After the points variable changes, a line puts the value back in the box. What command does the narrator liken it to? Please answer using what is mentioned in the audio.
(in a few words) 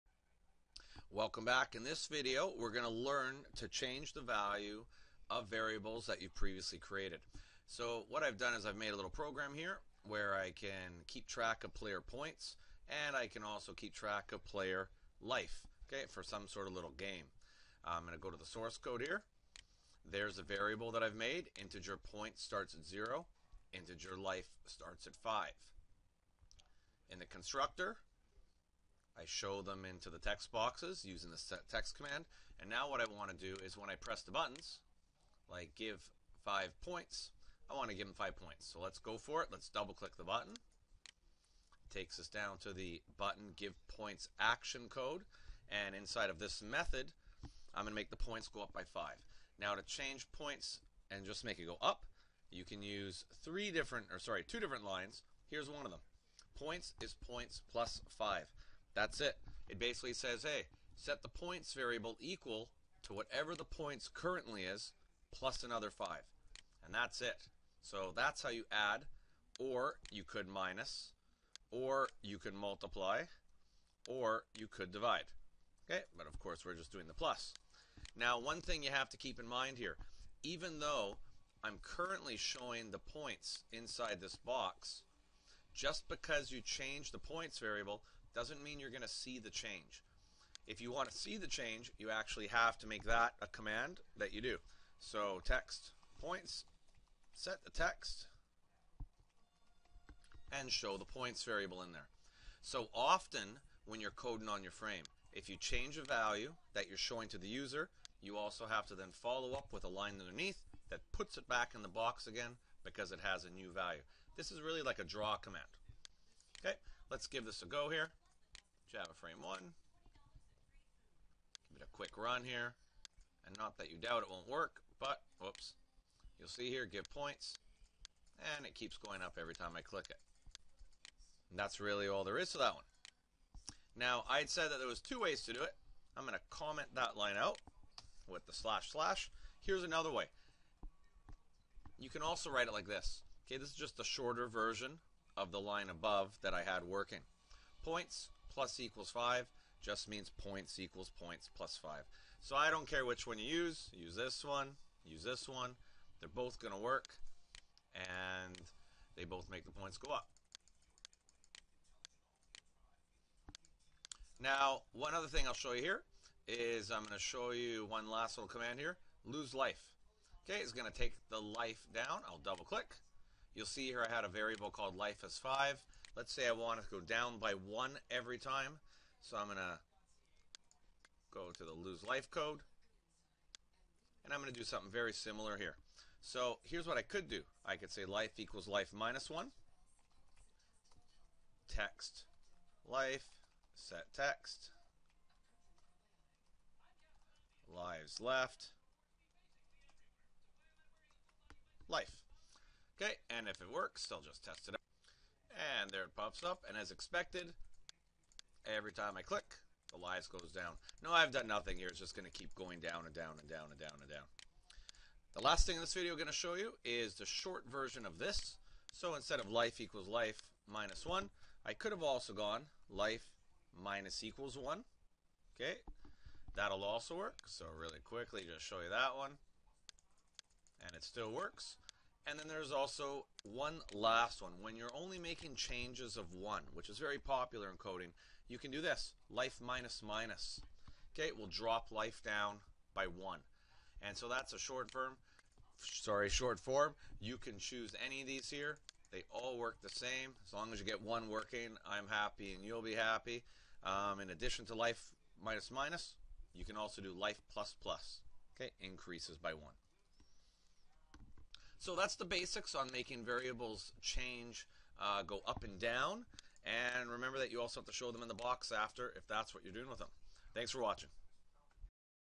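a draw command.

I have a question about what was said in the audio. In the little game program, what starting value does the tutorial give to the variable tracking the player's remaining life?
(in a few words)
5.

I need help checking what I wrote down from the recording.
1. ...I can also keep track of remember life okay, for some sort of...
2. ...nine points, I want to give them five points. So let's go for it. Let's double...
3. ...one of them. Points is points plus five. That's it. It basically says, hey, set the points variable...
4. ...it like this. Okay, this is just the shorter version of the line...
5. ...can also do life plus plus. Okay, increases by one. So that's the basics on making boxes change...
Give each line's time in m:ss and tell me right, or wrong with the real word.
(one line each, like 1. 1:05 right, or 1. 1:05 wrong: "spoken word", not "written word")
1. 0:13 wrong: "player", not "remember"
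2. 0:36 wrong: "five", not "nine"
3. 0:55 right
4. 2:22 right
5. 4:16 wrong: "variables", not "boxes".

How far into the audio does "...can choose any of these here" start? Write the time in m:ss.
4:07.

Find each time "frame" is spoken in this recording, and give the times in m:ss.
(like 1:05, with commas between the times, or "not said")
1:44, 1:59.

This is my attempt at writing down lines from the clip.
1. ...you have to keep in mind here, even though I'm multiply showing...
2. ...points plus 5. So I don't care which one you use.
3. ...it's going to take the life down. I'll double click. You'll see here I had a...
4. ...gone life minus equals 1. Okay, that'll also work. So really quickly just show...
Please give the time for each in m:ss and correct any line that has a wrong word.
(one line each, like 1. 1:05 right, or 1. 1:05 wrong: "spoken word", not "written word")
1. 1:18 wrong: "currently", not "multiply"
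2. 2:31 right
3. 2:50 right
4. 3:42 right.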